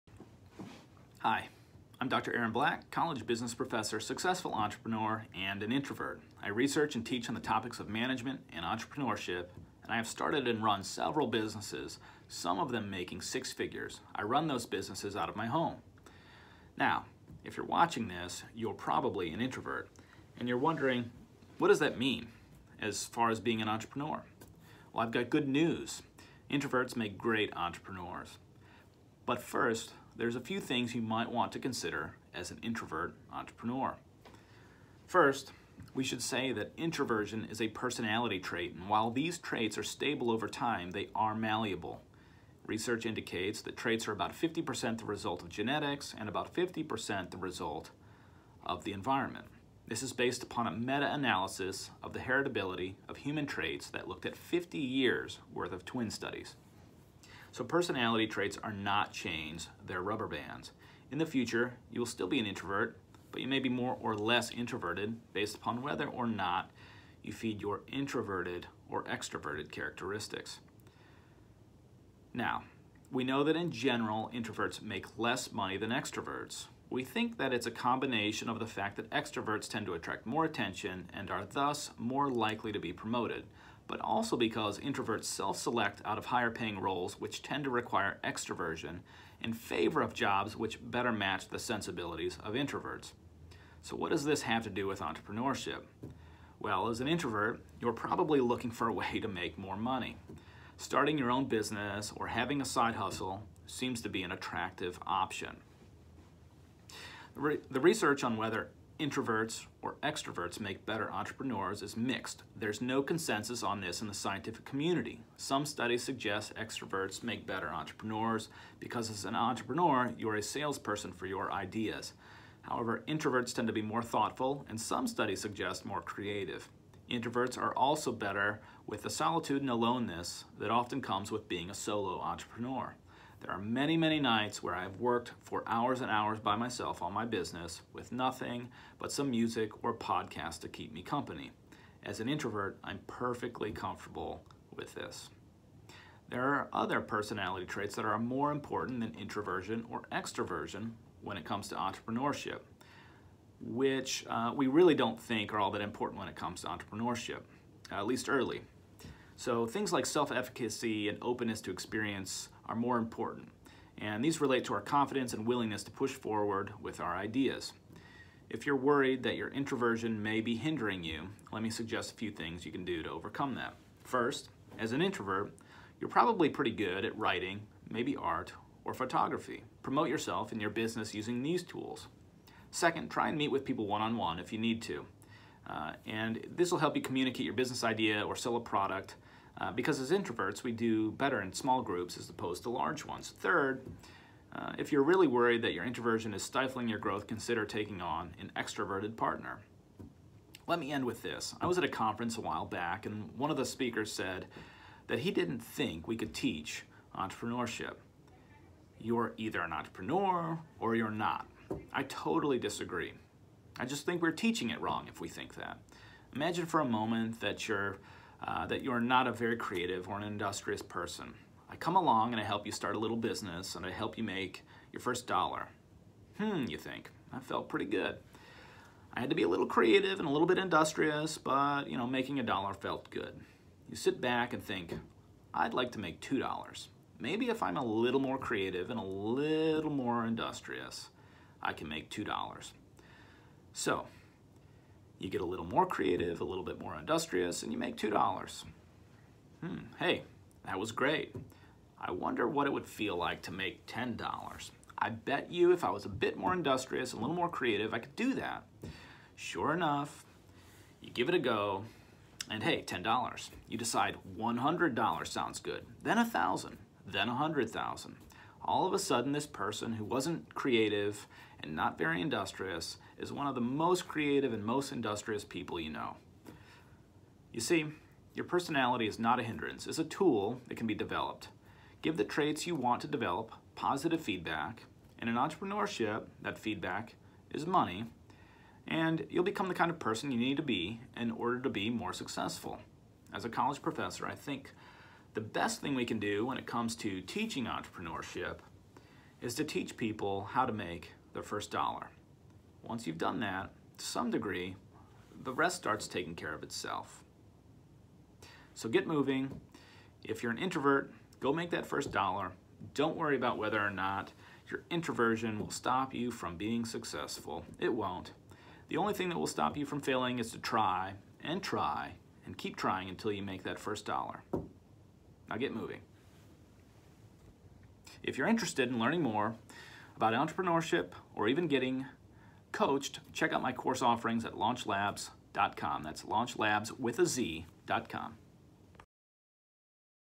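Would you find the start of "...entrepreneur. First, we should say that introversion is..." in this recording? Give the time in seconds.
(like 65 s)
33 s.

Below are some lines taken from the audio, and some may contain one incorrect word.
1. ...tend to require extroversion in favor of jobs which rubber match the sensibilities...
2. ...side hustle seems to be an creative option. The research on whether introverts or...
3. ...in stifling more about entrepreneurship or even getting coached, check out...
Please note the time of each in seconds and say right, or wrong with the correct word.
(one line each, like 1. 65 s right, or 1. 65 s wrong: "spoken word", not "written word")
1. 87 s wrong: "better", not "rubber"
2. 102 s wrong: "attractive", not "creative"
3. 328 s wrong: "learning", not "stifling".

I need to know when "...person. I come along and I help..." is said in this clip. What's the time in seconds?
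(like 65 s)
220 s.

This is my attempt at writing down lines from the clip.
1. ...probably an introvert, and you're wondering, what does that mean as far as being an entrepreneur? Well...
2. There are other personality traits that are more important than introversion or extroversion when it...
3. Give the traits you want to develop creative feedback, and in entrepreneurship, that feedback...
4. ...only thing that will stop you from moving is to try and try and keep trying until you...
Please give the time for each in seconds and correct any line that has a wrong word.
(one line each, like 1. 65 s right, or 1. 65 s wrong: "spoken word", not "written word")
1. 18 s right
2. 146 s right
3. 282 s wrong: "positive", not "creative"
4. 318 s wrong: "failing", not "moving".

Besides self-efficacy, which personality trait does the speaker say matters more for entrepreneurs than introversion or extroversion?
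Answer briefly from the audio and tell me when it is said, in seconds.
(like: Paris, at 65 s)
Openness to experience, at 161 s.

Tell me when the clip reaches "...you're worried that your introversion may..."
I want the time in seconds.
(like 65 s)
168 s.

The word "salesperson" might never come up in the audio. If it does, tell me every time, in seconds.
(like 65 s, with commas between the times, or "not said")
120 s.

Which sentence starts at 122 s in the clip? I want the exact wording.
However, introverts tend to be more thoughtful and some studies suggest more creative.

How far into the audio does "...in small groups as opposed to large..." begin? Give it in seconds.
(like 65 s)
191 s.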